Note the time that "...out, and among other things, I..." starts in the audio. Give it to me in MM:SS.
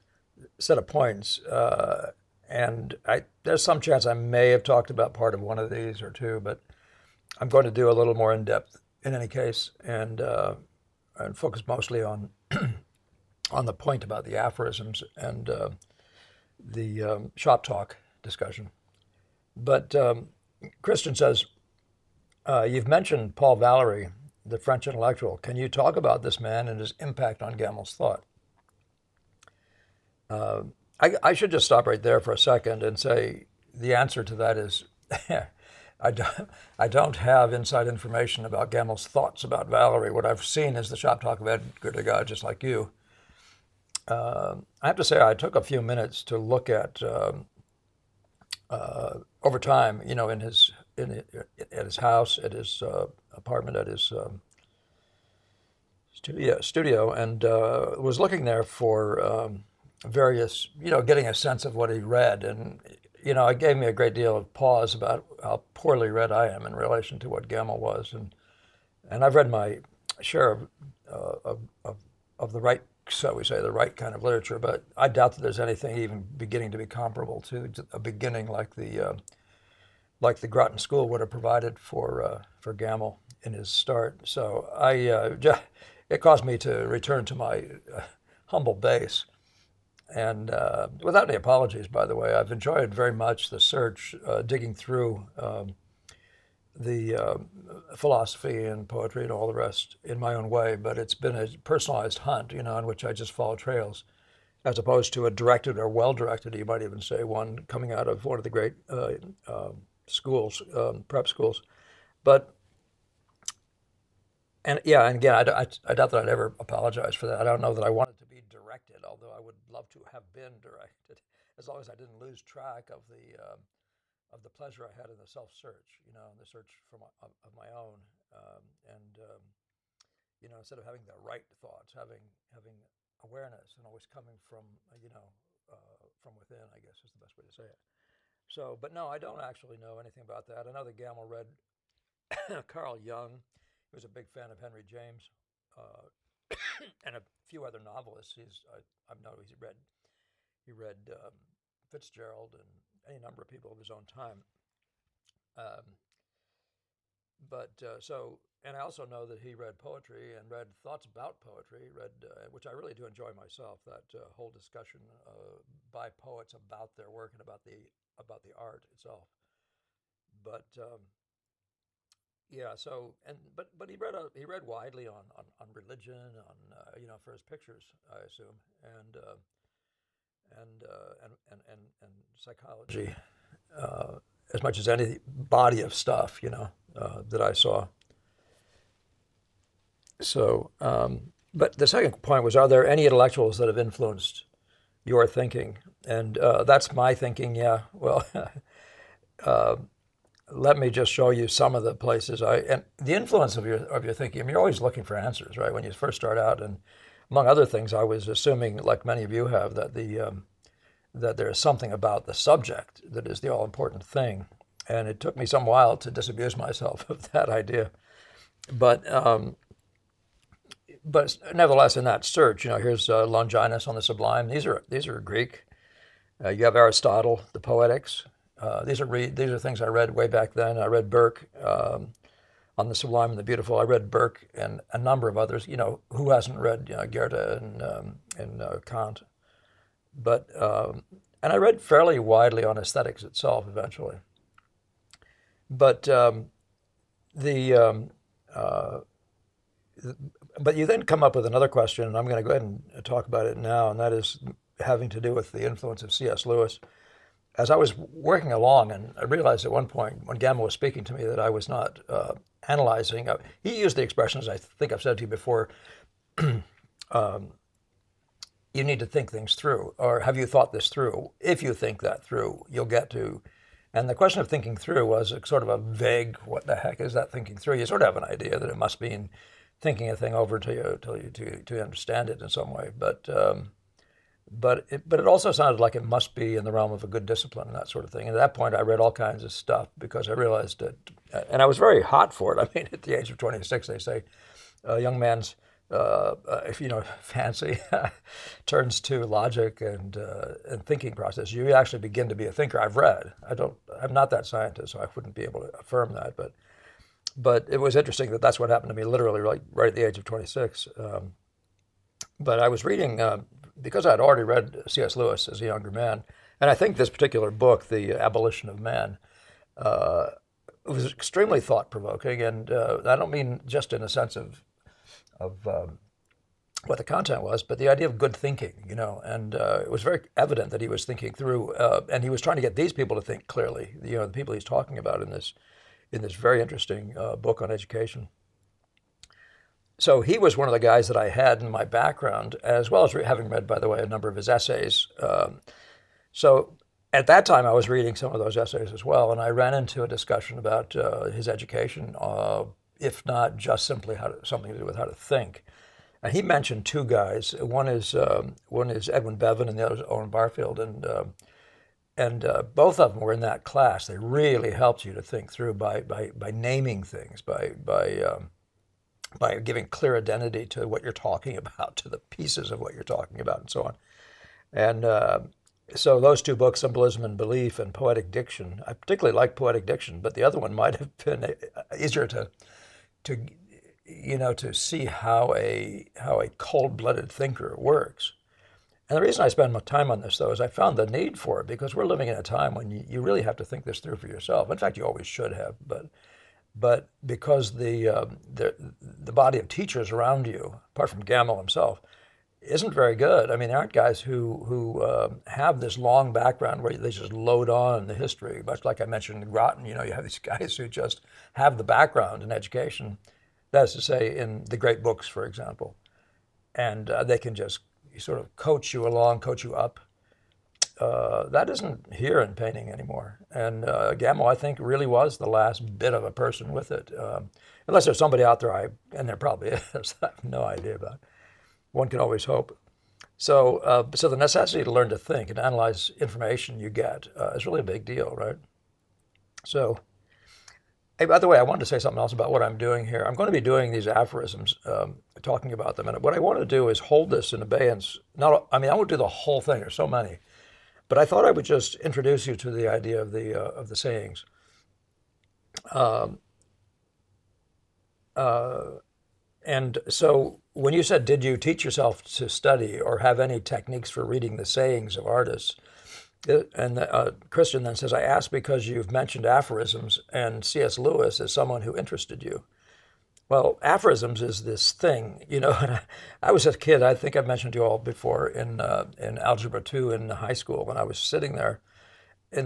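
03:26.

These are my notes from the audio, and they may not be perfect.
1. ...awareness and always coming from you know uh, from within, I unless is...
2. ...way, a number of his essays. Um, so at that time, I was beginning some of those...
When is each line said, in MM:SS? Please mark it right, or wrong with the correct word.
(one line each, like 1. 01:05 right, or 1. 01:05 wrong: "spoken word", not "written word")
1. 02:13 wrong: "guess", not "unless"
2. 05:43 wrong: "reading", not "beginning".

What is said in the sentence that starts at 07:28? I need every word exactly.
Not, I mean, I won't do the whole thing.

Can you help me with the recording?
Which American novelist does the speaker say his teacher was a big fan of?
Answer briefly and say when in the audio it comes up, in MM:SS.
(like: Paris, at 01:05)
Henry James, at 02:24.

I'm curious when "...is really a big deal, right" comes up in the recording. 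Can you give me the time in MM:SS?
07:17.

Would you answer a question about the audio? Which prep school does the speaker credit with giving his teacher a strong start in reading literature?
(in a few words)
Groton School.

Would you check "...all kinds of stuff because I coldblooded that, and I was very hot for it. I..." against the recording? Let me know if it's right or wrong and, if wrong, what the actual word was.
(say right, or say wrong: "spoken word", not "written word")
wrong: "realized", not "coldblooded".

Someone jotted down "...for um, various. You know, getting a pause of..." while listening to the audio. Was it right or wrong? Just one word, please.
wrong.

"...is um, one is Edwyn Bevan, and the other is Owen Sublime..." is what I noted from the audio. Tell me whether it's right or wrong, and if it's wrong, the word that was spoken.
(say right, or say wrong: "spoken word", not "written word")
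wrong: "Barfield", not "Sublime".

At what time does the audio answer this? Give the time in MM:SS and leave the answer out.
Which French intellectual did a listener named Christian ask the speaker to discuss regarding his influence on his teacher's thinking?
00:23.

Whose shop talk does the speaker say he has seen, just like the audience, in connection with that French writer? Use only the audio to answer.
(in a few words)
Edgar Degas.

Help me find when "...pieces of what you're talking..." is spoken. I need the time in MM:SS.
06:12.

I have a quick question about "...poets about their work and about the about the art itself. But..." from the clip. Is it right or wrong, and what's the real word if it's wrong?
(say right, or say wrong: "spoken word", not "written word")
right.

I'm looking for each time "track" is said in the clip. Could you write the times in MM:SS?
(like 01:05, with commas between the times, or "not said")
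02:02.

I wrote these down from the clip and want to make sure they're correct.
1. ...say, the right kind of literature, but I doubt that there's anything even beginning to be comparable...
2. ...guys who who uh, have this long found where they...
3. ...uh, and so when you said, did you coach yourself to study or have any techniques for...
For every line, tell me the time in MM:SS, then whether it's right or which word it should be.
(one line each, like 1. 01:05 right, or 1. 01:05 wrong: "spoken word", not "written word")
1. 01:13 right
2. 06:43 wrong: "background", not "found"
3. 07:38 wrong: "teach", not "coach".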